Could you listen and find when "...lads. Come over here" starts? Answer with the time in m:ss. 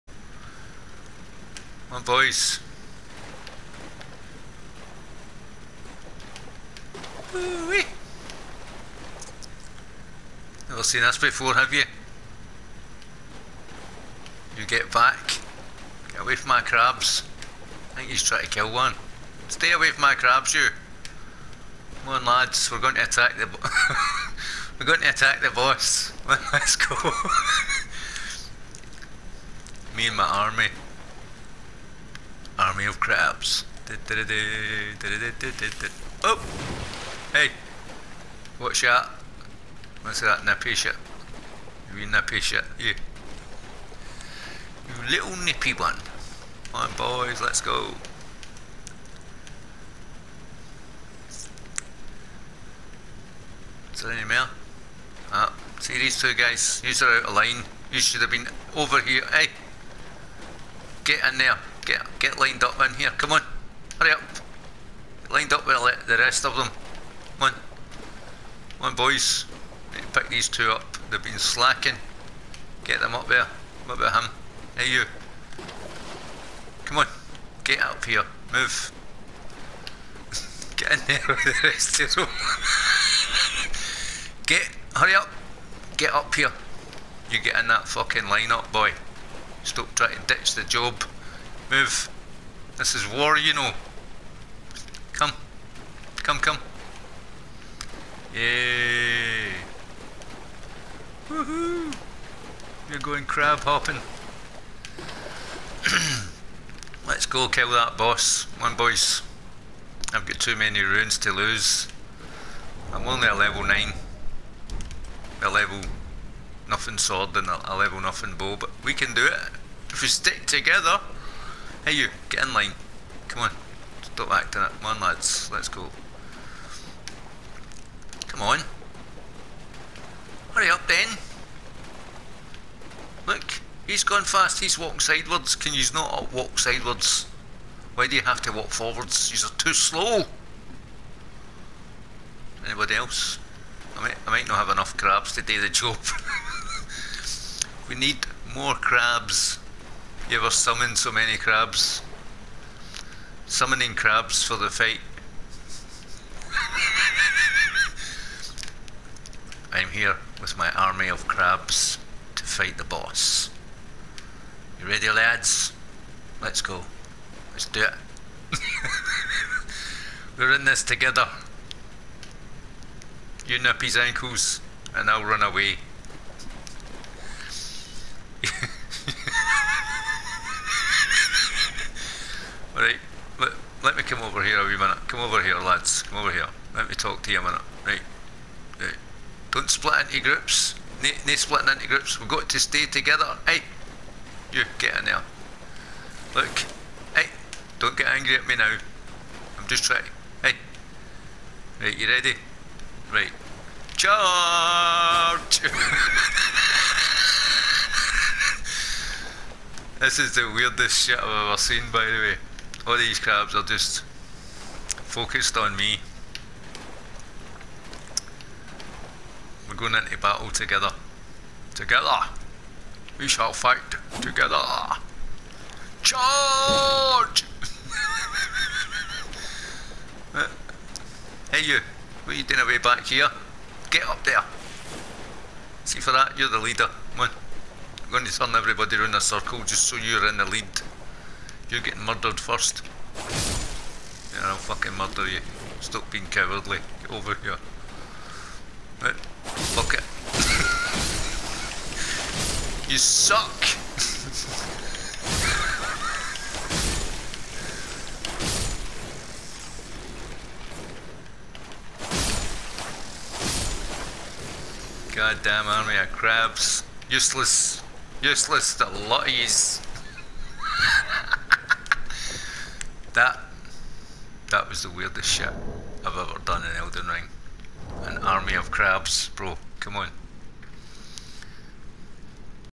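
3:05.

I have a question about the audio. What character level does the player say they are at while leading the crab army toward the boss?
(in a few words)
9.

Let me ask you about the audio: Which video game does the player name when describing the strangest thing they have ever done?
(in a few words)
Elden Ring.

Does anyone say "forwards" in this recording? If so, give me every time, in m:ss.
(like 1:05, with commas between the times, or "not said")
2:18.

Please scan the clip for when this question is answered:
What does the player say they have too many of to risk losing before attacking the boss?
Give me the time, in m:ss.
1:50.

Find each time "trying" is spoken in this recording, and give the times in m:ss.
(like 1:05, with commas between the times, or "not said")
0:18, 1:29, 3:19.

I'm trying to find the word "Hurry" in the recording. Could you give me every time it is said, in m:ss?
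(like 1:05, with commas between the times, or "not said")
1:03, 1:24, 2:10.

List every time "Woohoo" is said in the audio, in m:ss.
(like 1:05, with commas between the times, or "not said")
1:41.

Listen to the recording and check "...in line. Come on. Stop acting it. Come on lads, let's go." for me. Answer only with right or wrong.
right.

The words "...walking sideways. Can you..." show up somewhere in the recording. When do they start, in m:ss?
2:14.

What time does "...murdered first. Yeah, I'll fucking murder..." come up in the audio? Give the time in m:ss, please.
4:02.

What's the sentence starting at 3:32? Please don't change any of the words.
All these crabs are just focused on me.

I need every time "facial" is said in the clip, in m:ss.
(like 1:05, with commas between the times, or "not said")
not said.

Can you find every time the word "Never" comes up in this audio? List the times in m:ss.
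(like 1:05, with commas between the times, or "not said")
0:10.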